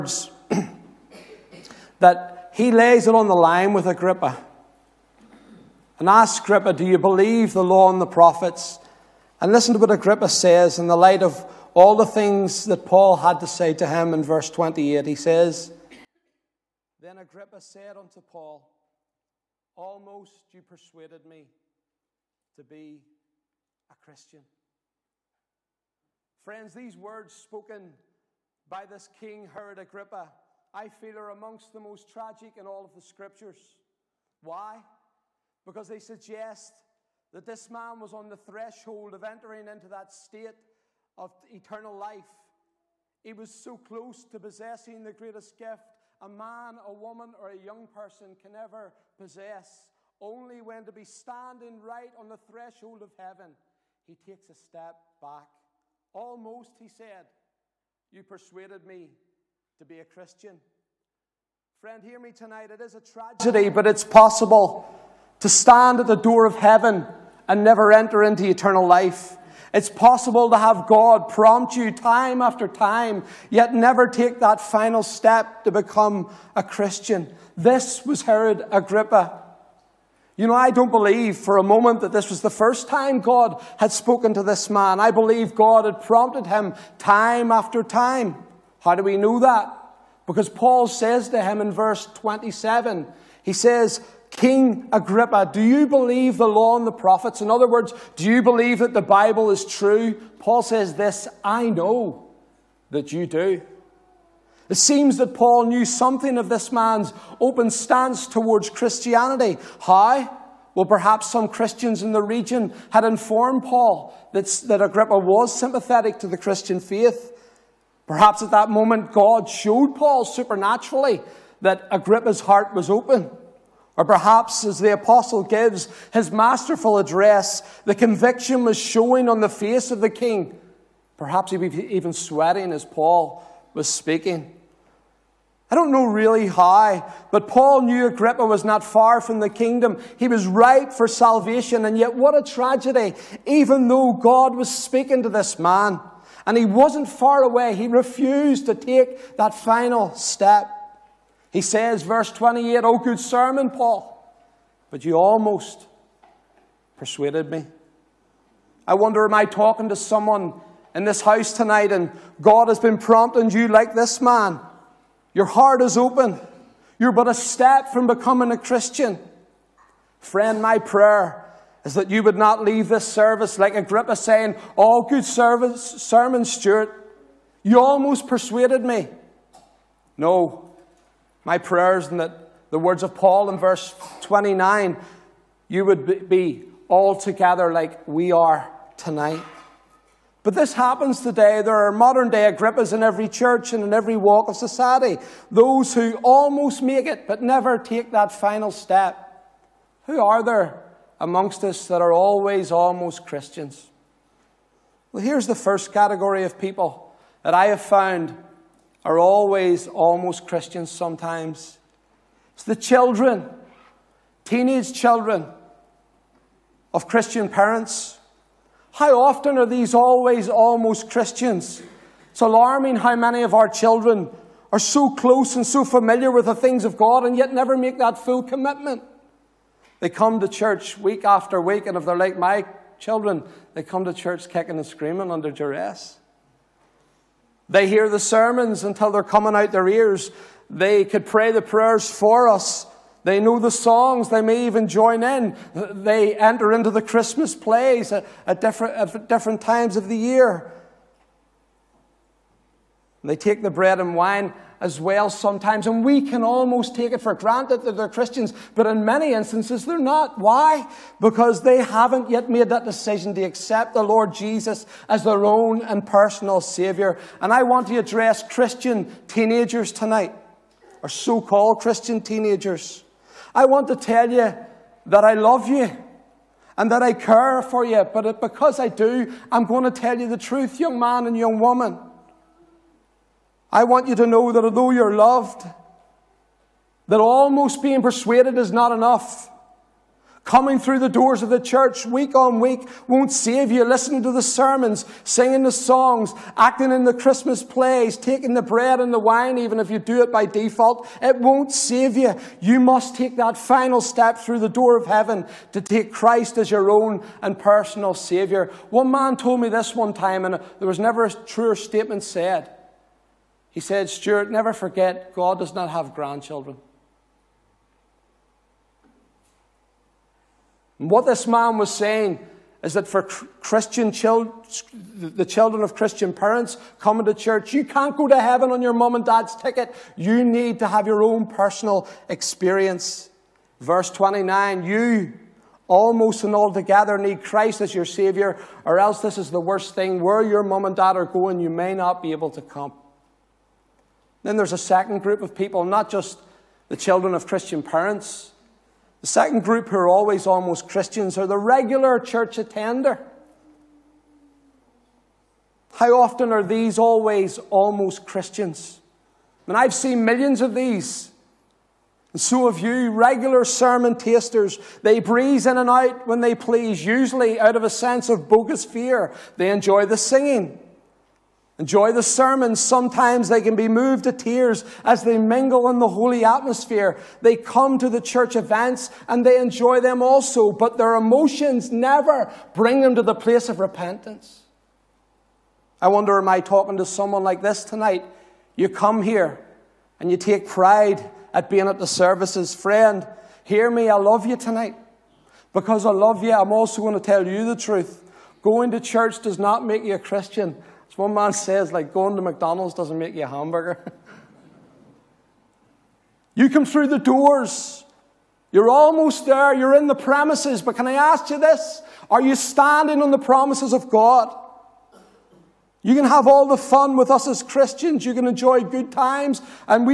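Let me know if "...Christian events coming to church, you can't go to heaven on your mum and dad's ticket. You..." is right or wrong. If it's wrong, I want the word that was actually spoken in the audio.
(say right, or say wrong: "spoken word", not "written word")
wrong: "parents", not "events".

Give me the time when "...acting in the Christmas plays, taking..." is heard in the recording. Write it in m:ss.
4:56.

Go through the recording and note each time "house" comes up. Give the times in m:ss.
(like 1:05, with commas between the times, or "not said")
2:41.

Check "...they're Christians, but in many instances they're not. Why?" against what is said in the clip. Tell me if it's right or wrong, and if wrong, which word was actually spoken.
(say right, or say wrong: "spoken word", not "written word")
right.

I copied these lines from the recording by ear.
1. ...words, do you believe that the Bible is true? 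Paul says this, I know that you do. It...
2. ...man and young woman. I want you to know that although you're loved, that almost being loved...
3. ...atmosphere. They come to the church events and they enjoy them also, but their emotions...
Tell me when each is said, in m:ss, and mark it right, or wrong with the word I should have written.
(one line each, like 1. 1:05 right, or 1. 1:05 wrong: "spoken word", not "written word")
1. 1:37 right
2. 4:40 wrong: "persuaded", not "loved"
3. 6:16 right.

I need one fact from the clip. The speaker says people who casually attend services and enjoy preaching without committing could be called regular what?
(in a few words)
Sermon tasters.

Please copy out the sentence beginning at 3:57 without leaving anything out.
They hear the sermons until they're coming out their ears.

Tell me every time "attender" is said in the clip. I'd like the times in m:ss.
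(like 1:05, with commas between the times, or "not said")
5:52.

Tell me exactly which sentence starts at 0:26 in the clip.
Friends, these words spoken by this King Herod Agrippa, I feel are amongst the most tragic in all of the scriptures.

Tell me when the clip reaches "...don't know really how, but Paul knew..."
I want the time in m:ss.
2:15.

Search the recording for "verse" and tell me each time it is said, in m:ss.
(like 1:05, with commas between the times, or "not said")
0:14, 1:31, 2:32, 3:03, 5:33.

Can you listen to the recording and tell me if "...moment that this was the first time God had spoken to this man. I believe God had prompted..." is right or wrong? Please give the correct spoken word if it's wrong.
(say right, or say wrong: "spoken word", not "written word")
right.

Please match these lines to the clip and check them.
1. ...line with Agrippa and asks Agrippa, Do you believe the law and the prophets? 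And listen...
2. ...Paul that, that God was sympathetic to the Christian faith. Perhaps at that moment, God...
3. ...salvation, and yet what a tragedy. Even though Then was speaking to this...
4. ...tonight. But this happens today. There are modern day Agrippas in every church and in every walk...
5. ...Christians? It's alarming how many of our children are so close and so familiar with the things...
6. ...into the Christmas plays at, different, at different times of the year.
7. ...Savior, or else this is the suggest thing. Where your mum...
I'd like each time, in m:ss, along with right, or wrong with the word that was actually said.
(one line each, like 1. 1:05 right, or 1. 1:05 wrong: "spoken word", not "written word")
1. 0:03 right
2. 1:53 wrong: "Agrippa", not "God"
3. 2:21 wrong: "God", not "Then"
4. 3:08 right
5. 3:41 right
6. 4:06 right
7. 5:38 wrong: "worst", not "suggest".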